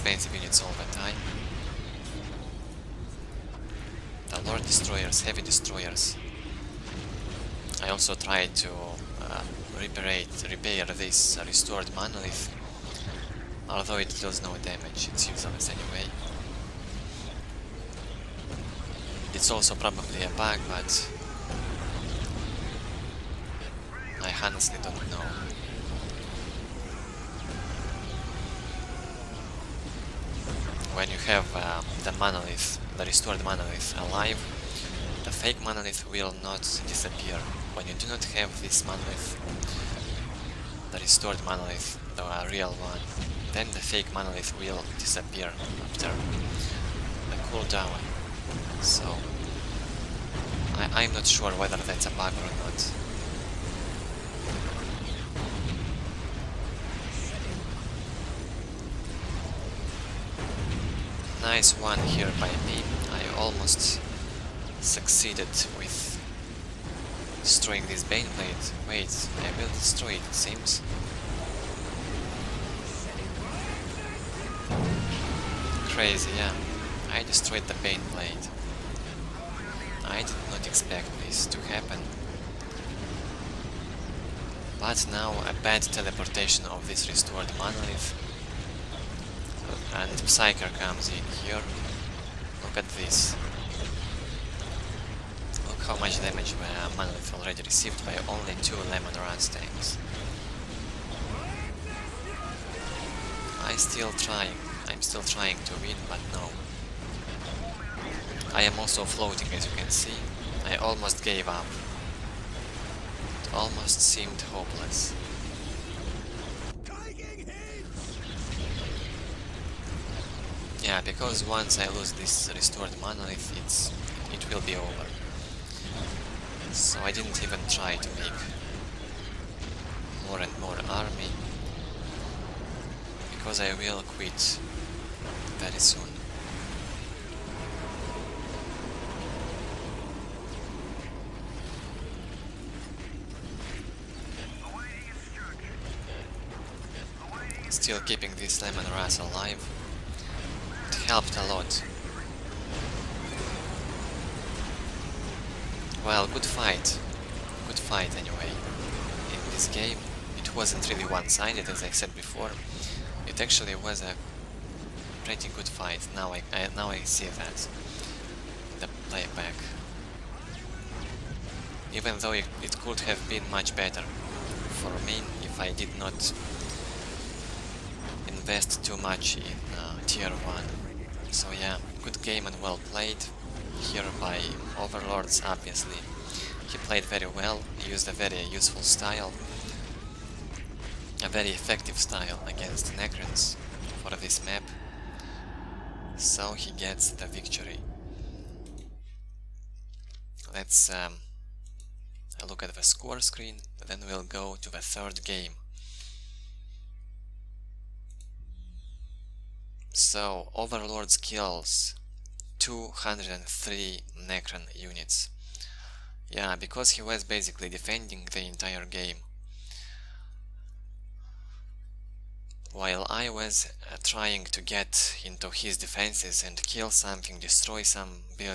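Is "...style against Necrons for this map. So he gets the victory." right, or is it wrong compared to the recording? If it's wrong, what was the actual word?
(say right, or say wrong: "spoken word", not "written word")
right.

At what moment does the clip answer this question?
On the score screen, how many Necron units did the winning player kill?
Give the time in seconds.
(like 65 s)
212 s.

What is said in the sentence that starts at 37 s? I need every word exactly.
When you do not have this monolith, the restored monolith, the real one, then the fake monolith will disappear after the cooldown.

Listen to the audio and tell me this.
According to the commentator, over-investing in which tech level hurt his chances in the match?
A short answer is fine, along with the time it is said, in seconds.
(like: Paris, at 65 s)
Tier 1, at 180 s.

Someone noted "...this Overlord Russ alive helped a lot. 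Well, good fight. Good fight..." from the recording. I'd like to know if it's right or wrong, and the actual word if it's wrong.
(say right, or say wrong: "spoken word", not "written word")
wrong: "Leman", not "Overlord".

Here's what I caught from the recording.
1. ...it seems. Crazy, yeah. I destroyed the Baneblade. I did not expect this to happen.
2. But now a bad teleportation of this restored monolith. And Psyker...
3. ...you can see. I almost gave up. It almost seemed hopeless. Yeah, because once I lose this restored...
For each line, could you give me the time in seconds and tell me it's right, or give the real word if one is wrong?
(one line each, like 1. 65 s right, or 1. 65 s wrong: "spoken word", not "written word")
1. 70 s right
2. 84 s right
3. 109 s right.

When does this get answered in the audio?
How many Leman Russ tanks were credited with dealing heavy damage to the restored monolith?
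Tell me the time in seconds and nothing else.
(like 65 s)
98 s.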